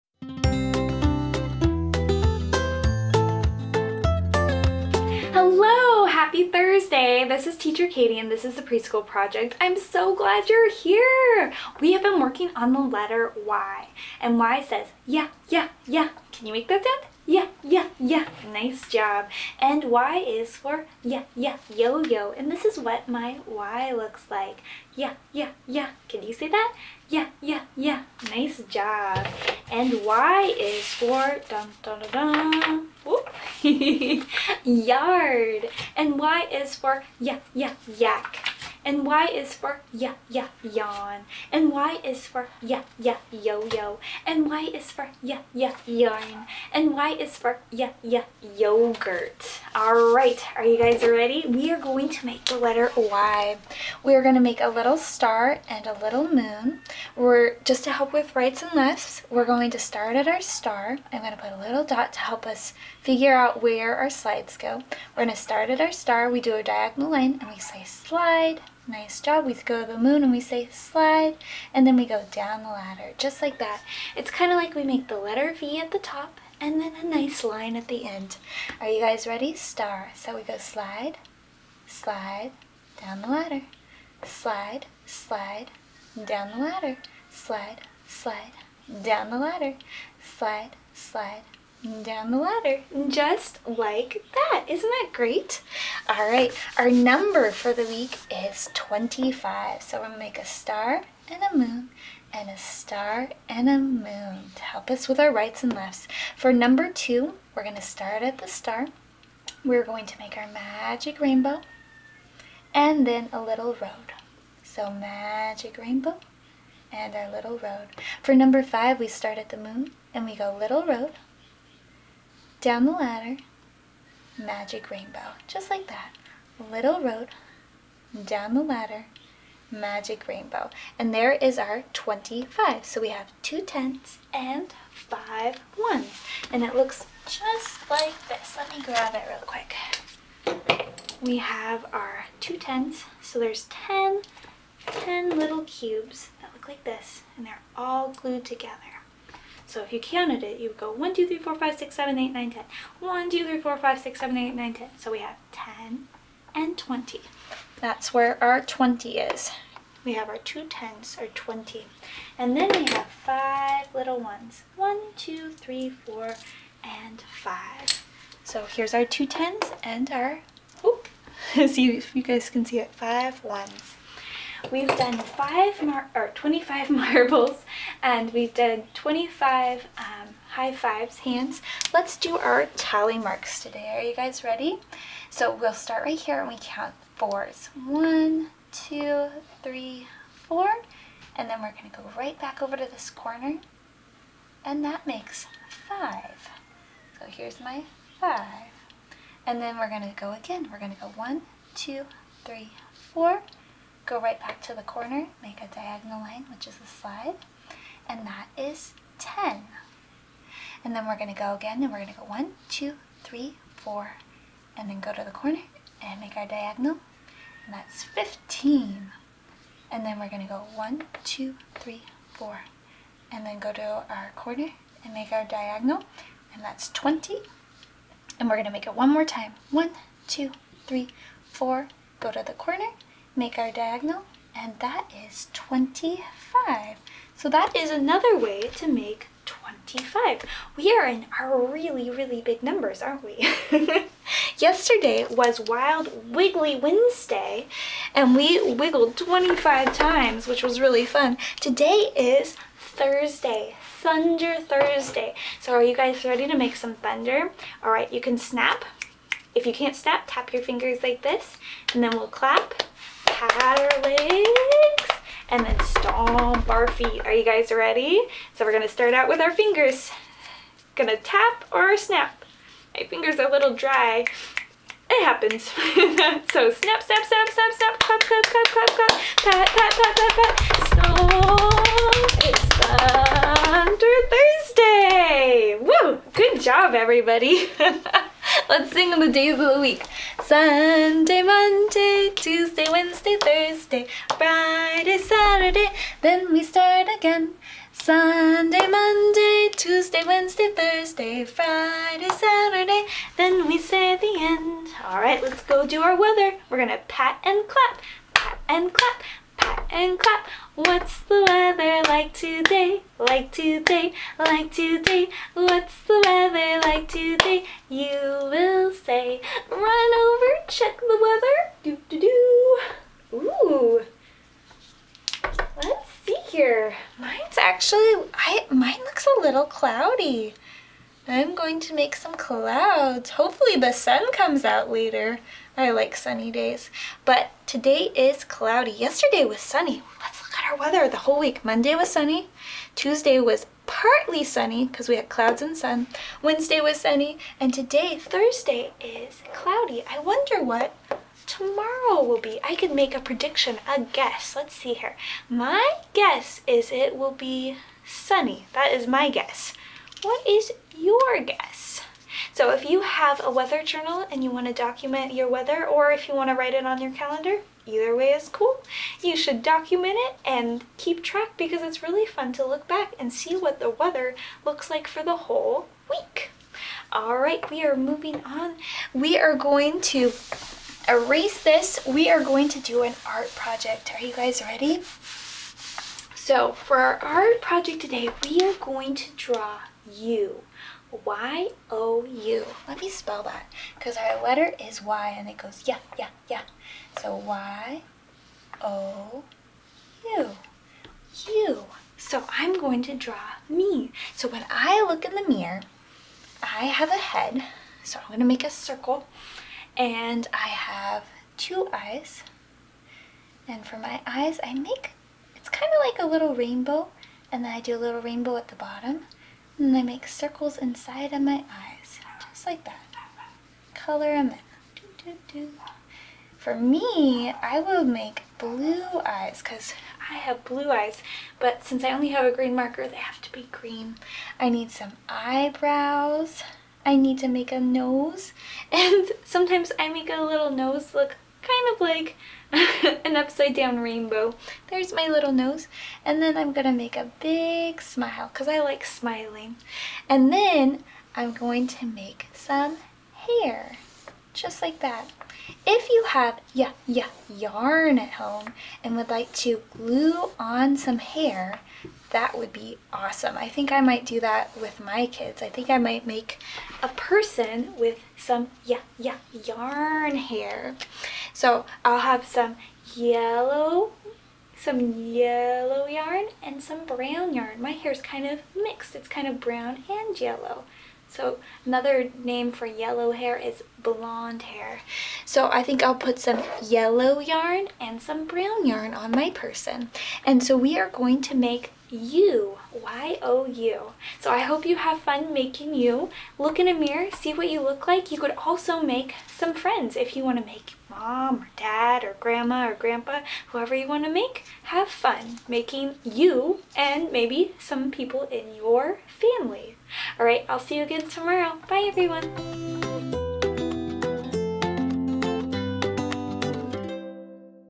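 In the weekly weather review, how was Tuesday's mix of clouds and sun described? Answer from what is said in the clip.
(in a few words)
Partly sunny.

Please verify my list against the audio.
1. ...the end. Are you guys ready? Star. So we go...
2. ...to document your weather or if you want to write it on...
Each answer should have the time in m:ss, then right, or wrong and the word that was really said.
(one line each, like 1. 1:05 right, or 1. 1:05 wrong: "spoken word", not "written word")
1. 1:17 right
2. 6:04 right.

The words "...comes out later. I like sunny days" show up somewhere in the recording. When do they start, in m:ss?
5:34.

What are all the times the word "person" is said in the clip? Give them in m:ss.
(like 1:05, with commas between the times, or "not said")
7:47, 8:09.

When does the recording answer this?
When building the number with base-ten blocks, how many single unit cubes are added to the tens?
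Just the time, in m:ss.
2:43.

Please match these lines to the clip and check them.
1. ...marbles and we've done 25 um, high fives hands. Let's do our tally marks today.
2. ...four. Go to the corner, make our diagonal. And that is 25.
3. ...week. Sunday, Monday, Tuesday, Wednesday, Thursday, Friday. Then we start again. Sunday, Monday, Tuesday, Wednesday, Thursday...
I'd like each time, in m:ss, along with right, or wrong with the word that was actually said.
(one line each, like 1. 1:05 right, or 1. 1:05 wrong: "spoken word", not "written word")
1. 2:56 right
2. 3:51 right
3. 4:49 right.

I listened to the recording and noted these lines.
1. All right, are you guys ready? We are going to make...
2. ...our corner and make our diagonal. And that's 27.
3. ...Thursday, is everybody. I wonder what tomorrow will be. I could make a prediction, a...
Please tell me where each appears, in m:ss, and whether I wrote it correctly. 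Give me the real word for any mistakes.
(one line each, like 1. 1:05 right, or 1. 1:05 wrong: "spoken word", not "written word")
1. 0:49 right
2. 3:44 wrong: "20", not "27"
3. 5:48 wrong: "cloudy", not "everybody".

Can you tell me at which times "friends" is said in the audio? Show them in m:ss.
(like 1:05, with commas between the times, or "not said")
8:19.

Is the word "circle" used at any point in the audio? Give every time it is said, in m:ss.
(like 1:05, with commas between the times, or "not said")
6:48, 7:00.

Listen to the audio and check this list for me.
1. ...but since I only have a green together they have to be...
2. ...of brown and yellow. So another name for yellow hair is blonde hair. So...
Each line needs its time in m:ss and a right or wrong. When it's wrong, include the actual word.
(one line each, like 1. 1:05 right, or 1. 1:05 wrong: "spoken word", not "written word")
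1. 7:11 wrong: "marker", not "together"
2. 7:59 right.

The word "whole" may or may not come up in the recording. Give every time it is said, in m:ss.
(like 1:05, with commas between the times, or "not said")
5:41, 6:15.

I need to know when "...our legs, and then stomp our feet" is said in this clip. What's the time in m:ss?
4:23.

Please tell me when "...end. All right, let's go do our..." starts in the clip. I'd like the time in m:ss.
5:04.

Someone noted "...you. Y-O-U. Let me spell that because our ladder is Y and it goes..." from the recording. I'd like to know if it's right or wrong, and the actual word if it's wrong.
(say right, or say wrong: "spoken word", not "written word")
wrong: "letter", not "ladder".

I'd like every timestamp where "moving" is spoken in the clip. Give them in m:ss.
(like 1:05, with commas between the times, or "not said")
6:17.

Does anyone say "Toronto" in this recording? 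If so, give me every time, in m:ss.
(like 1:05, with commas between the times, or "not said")
not said.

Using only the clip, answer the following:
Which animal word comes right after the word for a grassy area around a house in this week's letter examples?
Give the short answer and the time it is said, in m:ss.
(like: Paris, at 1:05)
Yak, at 0:37.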